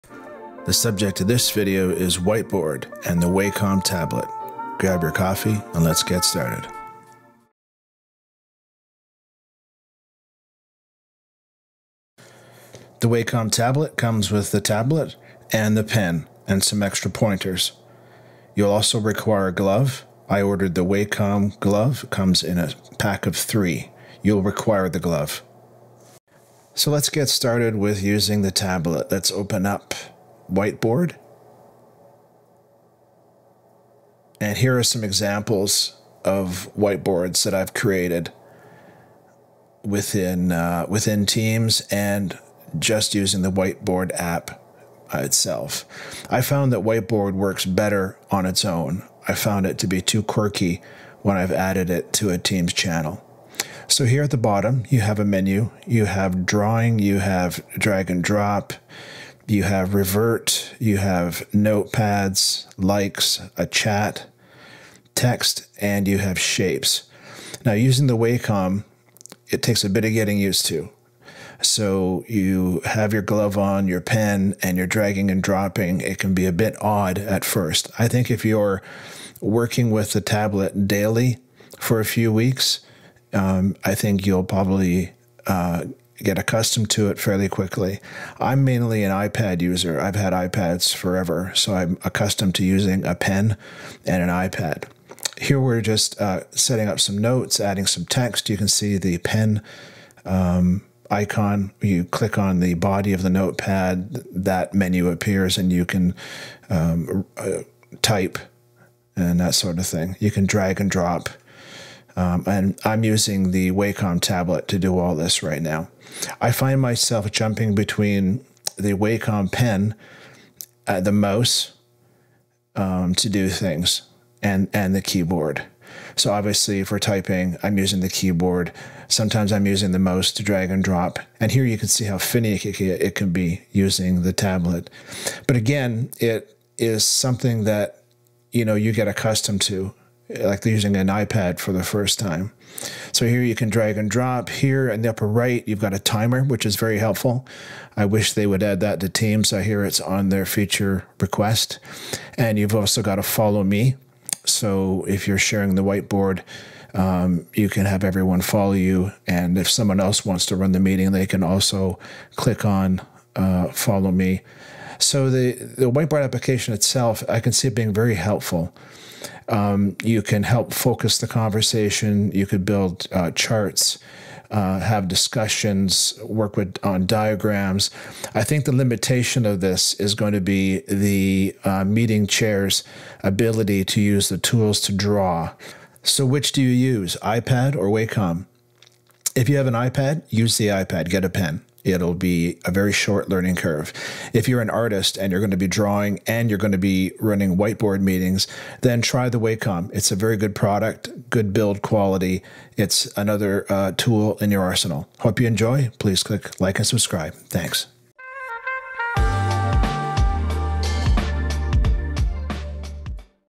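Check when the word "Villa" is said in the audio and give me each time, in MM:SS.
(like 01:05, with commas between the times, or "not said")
not said.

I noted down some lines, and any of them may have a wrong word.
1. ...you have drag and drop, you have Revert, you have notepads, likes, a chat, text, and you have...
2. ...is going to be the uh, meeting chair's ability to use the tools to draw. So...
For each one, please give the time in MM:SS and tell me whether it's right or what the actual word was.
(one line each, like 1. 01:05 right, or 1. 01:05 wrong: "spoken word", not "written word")
1. 00:56 right
2. 02:59 right.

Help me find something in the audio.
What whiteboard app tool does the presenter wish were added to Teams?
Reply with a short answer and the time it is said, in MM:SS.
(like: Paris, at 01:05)
timer, at 02:25.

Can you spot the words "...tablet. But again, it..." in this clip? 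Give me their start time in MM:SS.
02:14.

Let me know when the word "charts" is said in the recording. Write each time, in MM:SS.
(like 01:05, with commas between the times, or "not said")
02:53.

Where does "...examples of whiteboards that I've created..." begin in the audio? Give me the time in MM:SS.
00:35.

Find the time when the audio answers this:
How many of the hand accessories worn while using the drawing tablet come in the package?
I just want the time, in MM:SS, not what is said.
00:23.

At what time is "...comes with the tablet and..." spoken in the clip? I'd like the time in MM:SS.
00:13.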